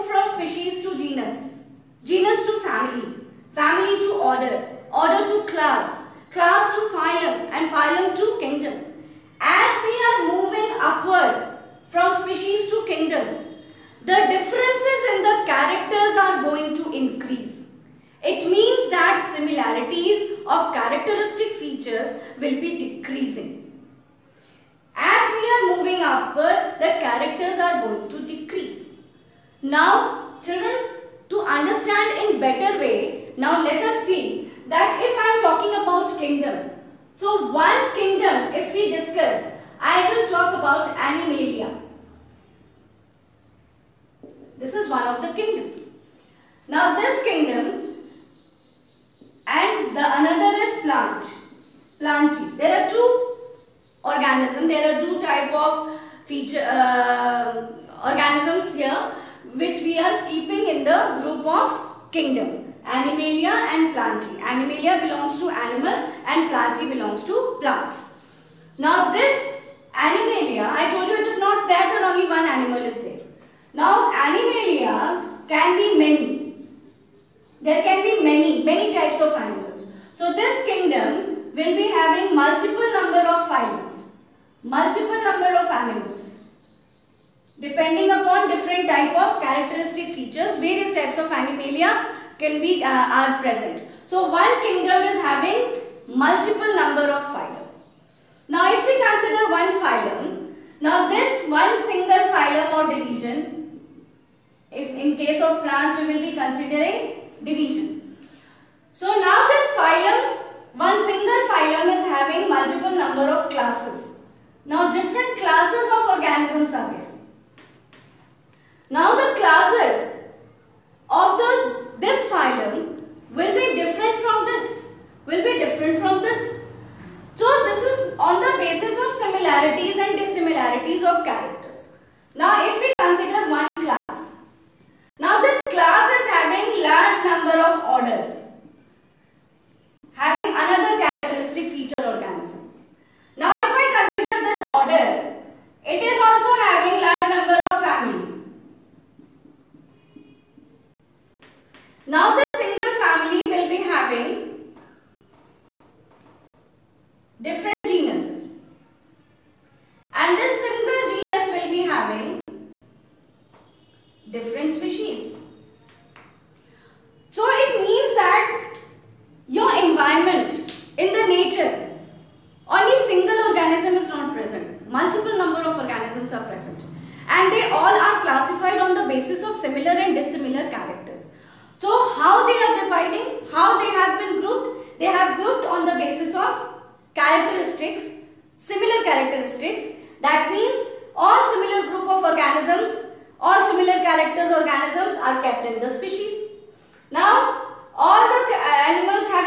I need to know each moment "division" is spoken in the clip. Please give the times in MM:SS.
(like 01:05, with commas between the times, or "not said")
01:42, 01:47.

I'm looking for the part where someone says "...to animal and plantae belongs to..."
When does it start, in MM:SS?
01:05.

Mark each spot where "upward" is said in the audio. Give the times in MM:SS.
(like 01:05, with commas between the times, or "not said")
00:10, 00:26.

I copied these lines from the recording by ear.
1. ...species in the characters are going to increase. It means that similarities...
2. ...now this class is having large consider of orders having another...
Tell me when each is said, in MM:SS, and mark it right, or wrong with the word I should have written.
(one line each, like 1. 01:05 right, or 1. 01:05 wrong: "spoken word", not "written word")
1. 00:14 wrong: "differences", not "species"
2. 02:15 wrong: "number", not "consider".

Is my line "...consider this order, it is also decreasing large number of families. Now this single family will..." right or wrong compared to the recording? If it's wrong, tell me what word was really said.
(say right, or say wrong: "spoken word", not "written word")
wrong: "having", not "decreasing".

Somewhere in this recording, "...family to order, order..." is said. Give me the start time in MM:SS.
00:03.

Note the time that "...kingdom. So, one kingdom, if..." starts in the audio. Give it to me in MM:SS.
00:36.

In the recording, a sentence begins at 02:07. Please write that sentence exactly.
So this is on the basis of similarities and dissimilarities of characters.